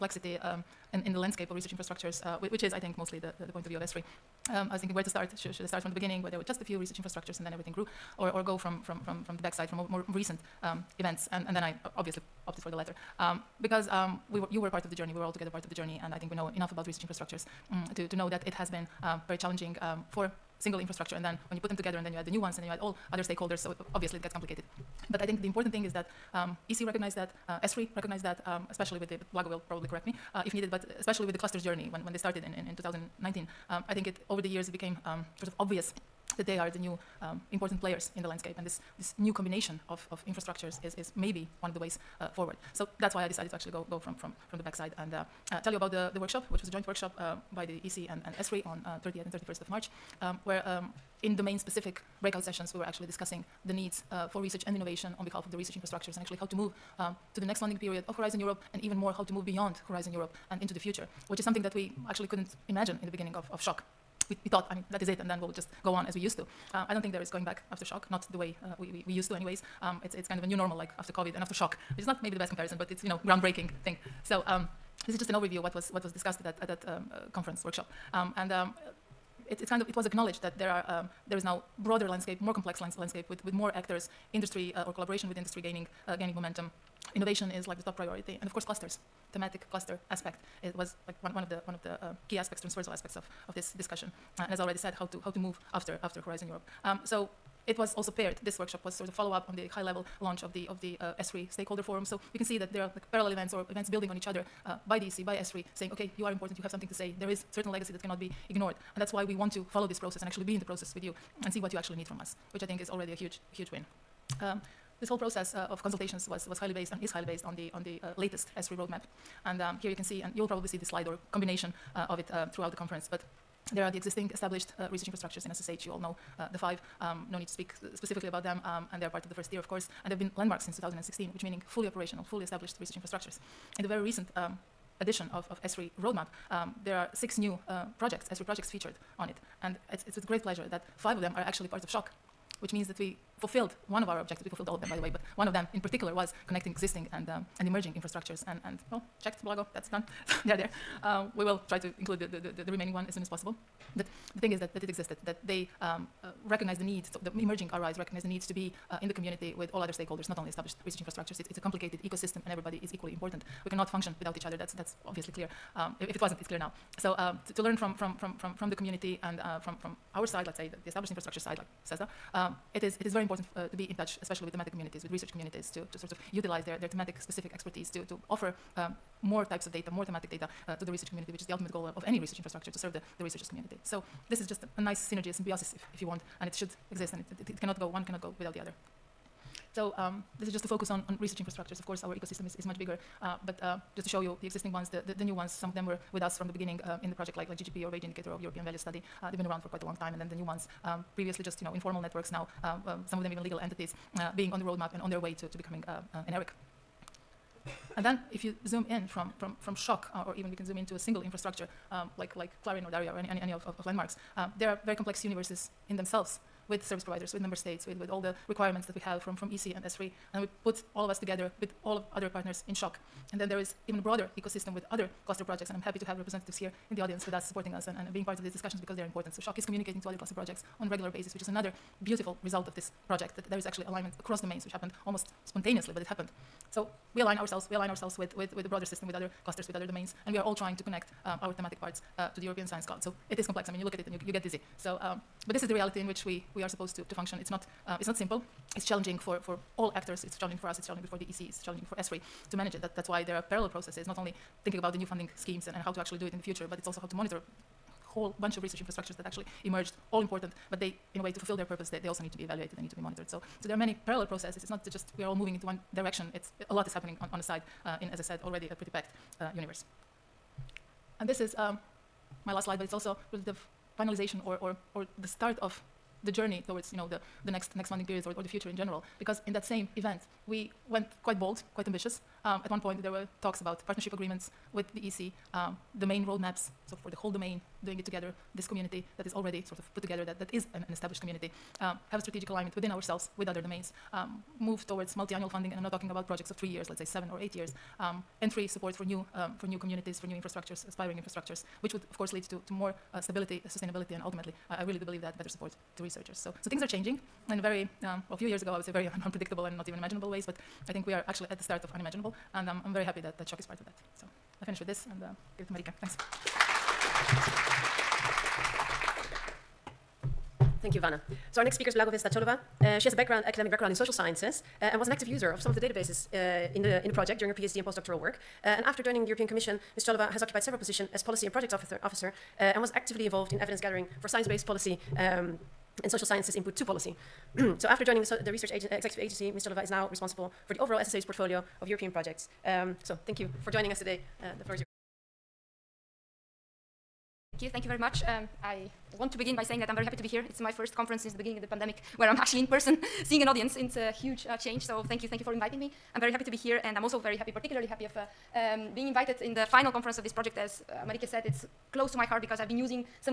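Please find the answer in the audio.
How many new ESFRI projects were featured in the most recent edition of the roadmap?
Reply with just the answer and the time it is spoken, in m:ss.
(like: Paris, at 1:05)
6, at 2:17.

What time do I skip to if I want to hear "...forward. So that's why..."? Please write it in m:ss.
0:42.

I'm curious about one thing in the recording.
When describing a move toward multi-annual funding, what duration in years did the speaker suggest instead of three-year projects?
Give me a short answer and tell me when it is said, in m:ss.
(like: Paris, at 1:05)
7 or 8 years, at 4:57.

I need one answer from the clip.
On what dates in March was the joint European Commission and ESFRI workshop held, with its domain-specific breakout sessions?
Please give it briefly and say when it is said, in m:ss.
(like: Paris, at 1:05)
30th and 31st of March, at 0:49.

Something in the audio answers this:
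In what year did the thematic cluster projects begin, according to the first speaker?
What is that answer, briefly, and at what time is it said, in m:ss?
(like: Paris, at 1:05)
2019, at 0:32.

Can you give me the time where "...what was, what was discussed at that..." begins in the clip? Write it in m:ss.
1:15.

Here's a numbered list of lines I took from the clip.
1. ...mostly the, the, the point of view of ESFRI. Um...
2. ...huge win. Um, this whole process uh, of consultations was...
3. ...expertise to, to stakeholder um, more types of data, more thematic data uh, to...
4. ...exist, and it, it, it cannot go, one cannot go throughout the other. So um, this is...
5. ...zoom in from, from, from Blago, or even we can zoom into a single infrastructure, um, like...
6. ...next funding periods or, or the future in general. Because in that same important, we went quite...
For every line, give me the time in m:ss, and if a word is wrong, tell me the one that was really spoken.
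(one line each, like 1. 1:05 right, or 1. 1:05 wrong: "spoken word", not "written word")
1. 0:02 right
2. 1:53 right
3. 2:57 wrong: "offer", not "stakeholder"
4. 3:06 wrong: "without", not "throughout"
5. 3:28 wrong: "SSHOC", not "Blago"
6. 4:37 wrong: "event", not "important".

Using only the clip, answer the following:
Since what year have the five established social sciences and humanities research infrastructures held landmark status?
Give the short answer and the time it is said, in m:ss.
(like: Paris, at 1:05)
2016, at 2:10.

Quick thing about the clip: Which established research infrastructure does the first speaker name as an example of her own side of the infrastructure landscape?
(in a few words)
CESSDA.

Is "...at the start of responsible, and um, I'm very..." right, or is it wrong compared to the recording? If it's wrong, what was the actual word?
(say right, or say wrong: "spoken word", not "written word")
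wrong: "unimaginable", not "responsible".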